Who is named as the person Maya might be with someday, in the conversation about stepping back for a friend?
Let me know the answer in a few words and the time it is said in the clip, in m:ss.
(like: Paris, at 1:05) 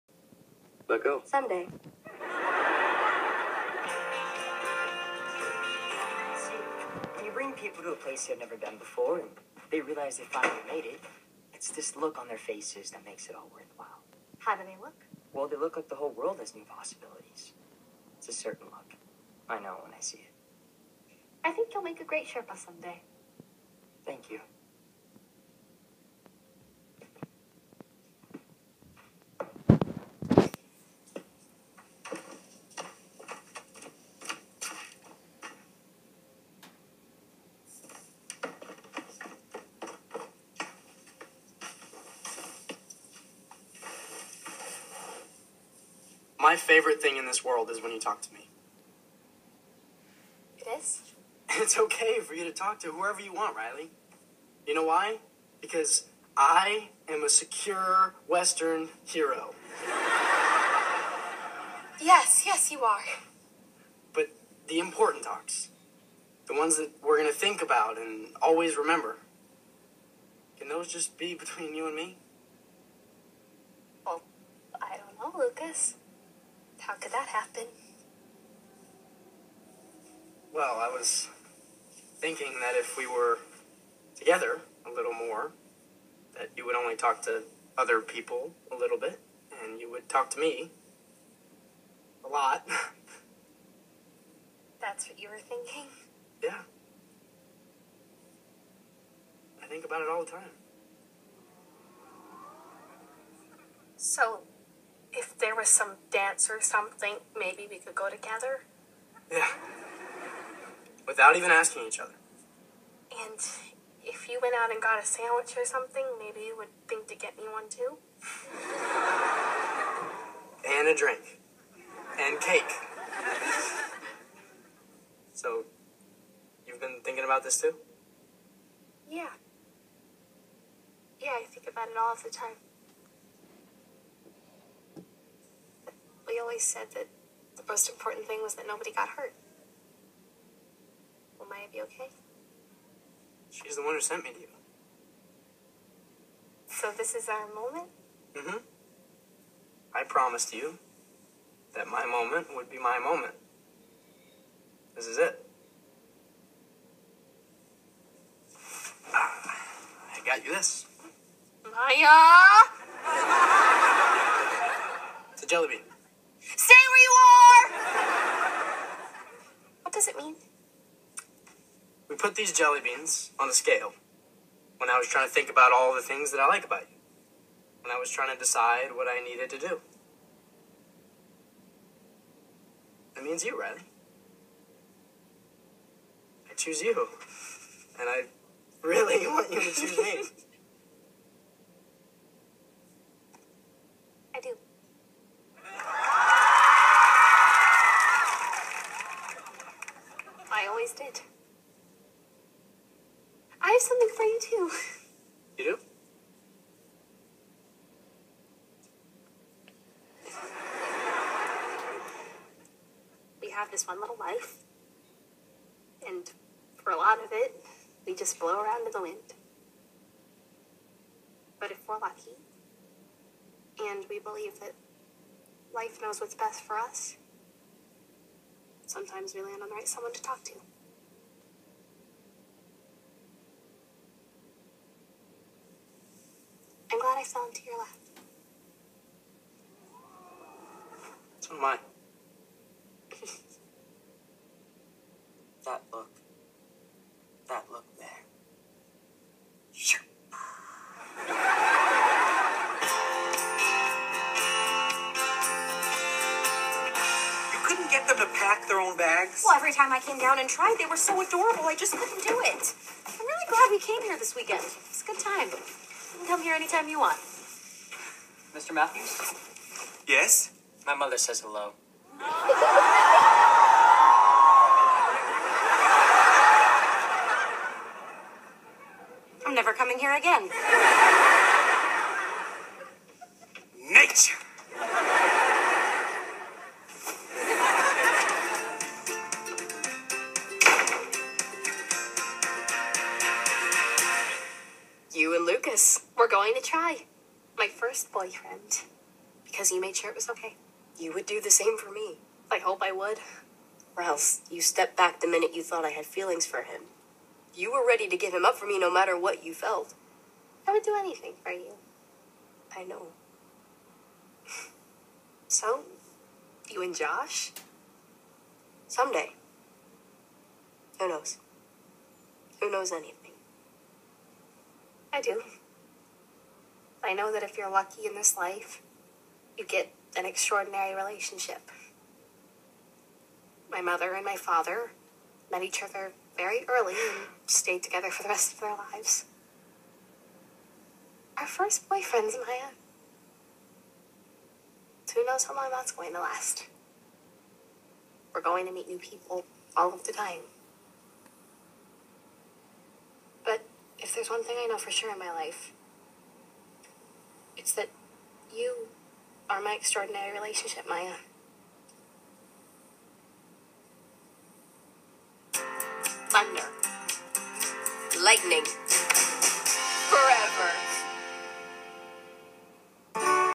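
Josh, at 5:16.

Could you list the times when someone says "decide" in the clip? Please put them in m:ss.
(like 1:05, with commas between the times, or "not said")
2:58.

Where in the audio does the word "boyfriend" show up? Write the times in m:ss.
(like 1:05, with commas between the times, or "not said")
4:58, 5:41.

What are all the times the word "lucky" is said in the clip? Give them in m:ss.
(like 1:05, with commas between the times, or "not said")
3:41, 5:27.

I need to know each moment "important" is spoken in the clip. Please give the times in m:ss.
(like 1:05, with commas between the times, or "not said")
1:04, 2:17.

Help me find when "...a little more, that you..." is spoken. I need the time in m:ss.
1:24.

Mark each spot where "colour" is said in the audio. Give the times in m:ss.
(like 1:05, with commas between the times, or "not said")
not said.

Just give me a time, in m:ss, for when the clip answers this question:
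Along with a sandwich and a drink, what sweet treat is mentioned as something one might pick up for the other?
2:02.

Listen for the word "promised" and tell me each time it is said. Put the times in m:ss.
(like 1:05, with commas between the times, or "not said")
2:30.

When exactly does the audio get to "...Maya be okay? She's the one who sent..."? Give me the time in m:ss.
2:21.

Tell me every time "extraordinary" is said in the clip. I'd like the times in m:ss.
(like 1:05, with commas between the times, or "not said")
5:30, 5:59.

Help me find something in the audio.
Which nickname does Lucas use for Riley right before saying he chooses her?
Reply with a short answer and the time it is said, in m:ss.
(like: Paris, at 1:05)
Red, at 3:03.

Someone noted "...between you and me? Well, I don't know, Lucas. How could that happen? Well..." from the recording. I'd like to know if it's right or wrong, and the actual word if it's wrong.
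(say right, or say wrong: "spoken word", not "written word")
right.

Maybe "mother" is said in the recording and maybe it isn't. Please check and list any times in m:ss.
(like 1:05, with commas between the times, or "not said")
4:30, 5:33.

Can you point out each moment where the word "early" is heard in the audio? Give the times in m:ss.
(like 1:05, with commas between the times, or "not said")
5:36.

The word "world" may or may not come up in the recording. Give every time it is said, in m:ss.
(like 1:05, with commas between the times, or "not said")
0:16, 0:47.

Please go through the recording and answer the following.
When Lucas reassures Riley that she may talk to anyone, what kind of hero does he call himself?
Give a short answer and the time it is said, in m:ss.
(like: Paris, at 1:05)
secure Western hero, at 0:57.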